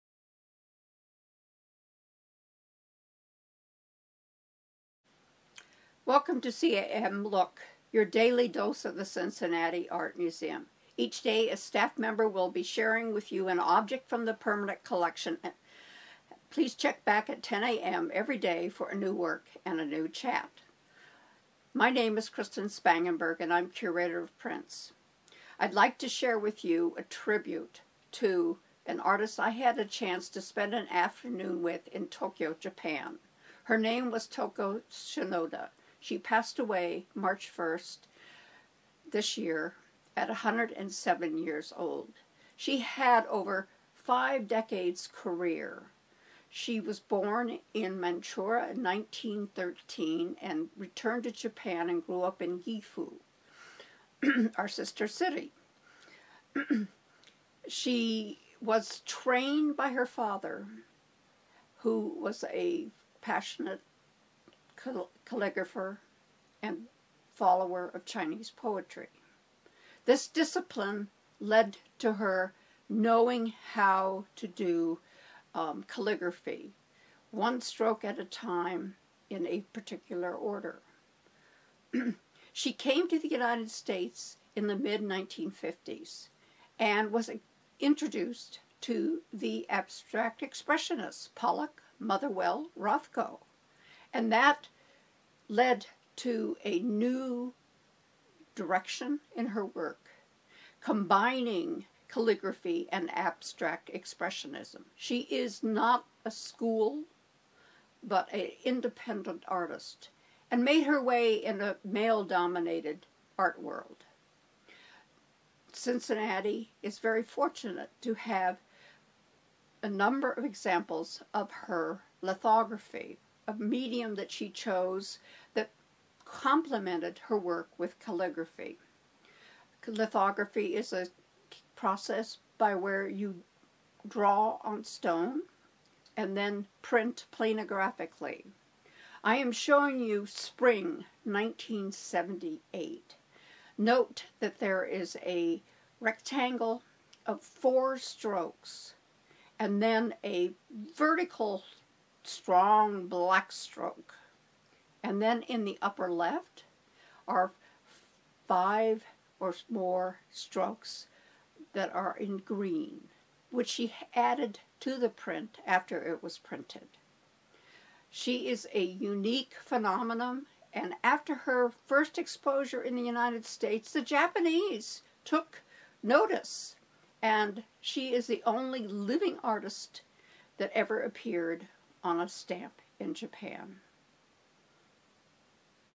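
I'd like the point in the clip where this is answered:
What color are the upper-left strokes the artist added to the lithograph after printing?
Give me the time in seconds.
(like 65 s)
162 s.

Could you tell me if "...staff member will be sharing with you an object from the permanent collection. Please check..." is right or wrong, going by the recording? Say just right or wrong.
right.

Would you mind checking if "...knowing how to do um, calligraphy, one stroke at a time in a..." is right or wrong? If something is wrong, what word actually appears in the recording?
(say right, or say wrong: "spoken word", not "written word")
right.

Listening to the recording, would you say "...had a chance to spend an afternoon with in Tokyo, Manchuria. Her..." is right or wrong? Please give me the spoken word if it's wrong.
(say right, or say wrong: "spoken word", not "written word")
wrong: "Japan", not "Manchuria".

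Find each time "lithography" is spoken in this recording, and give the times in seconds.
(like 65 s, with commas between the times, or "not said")
122 s, 129 s.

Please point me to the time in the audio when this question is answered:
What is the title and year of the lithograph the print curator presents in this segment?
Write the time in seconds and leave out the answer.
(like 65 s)
140 s.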